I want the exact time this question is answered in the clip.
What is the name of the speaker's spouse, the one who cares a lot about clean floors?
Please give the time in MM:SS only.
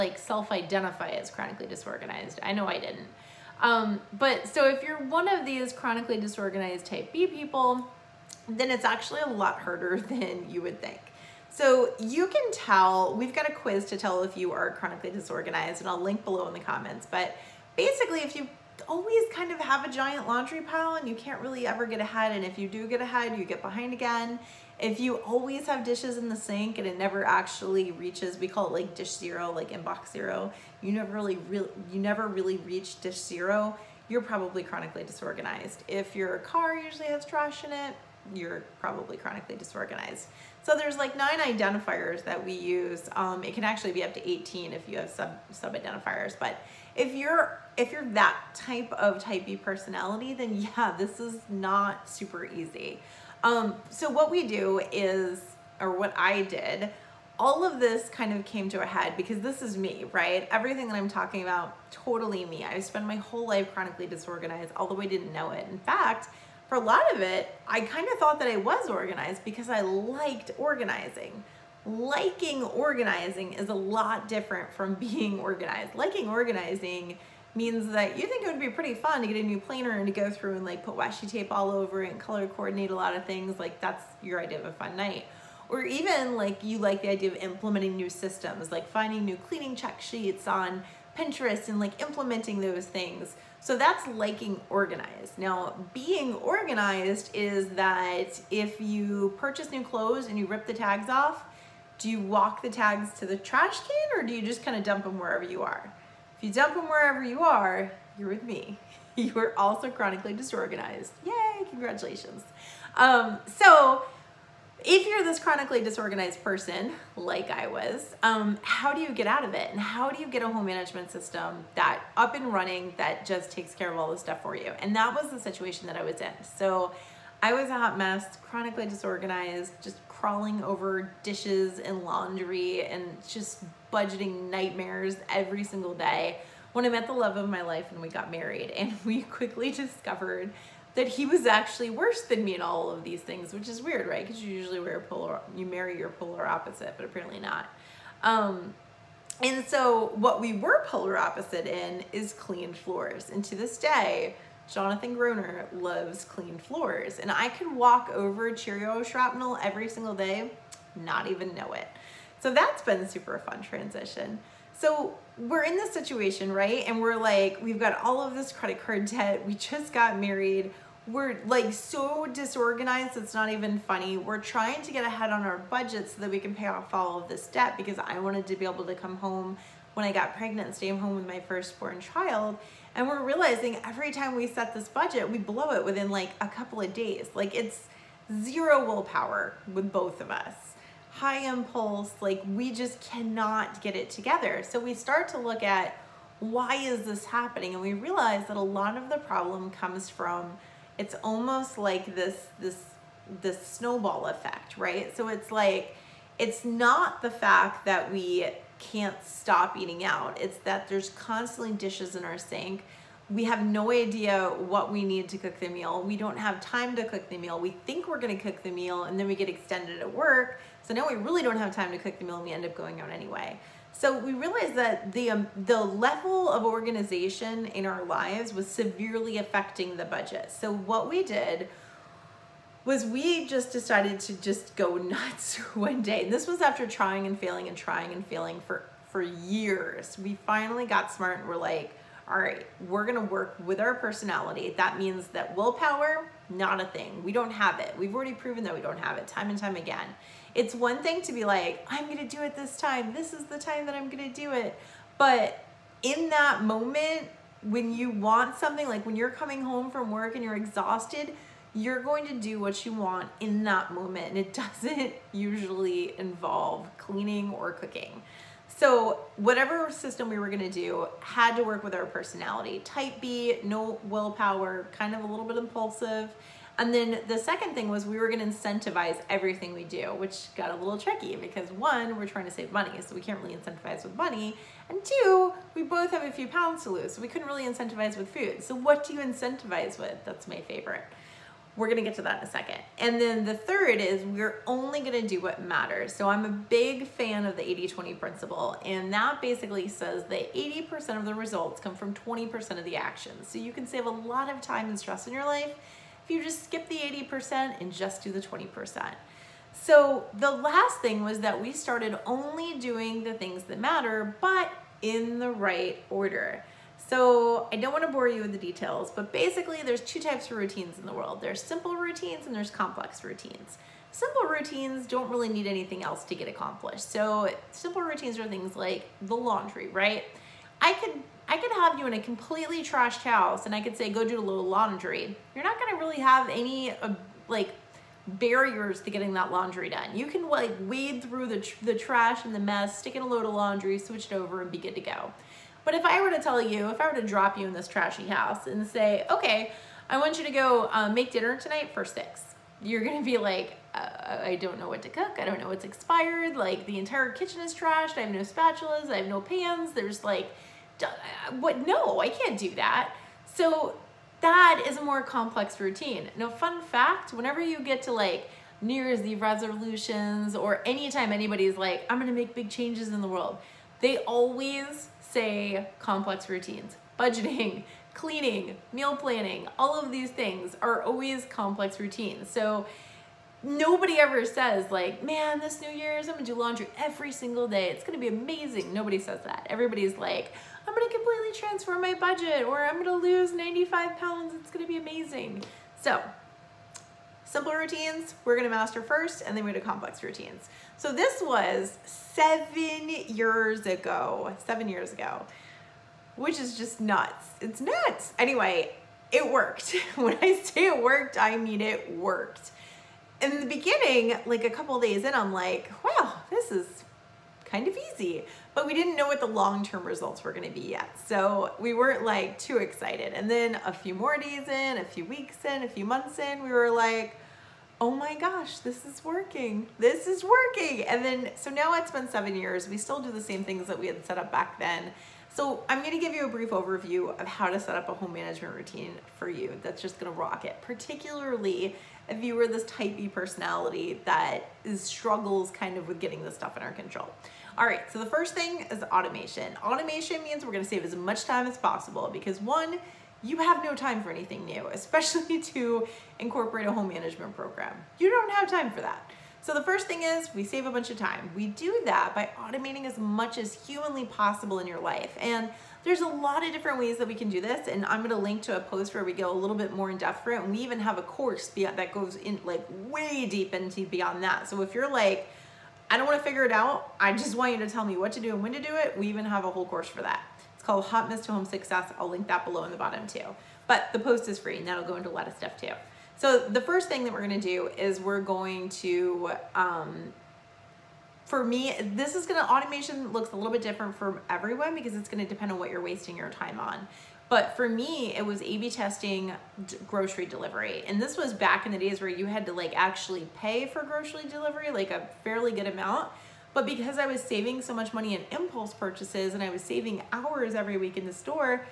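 02:34.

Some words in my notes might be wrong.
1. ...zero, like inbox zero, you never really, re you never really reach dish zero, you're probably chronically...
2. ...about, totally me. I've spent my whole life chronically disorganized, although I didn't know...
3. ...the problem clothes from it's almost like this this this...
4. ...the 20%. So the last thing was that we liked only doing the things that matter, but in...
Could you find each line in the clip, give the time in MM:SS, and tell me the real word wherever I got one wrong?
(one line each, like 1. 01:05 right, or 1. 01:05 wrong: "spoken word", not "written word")
1. 00:29 right
2. 01:01 right
3. 03:19 wrong: "comes", not "clothes"
4. 05:08 wrong: "started", not "liked".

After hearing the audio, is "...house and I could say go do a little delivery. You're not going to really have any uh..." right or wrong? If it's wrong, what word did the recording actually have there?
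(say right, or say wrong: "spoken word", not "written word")
wrong: "laundry", not "delivery".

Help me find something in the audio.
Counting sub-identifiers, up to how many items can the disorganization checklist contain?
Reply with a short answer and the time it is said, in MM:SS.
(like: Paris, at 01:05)
18, at 00:44.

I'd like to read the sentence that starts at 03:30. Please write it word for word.
It's that there's constantly dishes in our sink.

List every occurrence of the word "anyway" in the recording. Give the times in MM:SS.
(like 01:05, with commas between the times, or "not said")
03:43, 06:48.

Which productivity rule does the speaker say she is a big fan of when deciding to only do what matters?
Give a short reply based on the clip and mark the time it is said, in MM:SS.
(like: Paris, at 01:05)
80-20 principle, at 04:57.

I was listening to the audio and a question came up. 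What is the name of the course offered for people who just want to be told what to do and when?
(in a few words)
Hot Mess to Home Success.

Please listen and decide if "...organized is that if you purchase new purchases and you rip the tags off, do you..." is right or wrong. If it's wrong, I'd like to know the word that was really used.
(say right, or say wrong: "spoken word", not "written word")
wrong: "clothes", not "purchases".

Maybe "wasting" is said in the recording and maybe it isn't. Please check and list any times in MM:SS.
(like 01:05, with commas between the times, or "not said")
08:16.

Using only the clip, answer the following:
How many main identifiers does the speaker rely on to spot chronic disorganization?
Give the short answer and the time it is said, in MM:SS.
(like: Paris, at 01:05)
9, at 00:41.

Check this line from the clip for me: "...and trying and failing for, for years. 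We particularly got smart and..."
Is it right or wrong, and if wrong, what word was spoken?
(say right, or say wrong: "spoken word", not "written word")
wrong: "finally", not "particularly".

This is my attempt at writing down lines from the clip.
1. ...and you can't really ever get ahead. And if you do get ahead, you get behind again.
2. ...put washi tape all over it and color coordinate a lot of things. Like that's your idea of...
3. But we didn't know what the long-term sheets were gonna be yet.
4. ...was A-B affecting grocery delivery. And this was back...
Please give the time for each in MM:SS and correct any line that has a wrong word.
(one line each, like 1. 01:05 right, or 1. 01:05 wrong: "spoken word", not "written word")
1. 00:20 right
2. 01:20 right
3. 06:58 wrong: "results", not "sheets"
4. 08:18 wrong: "testing", not "affecting".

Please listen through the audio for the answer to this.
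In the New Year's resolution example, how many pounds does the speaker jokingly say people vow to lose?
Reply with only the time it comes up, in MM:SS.
06:33.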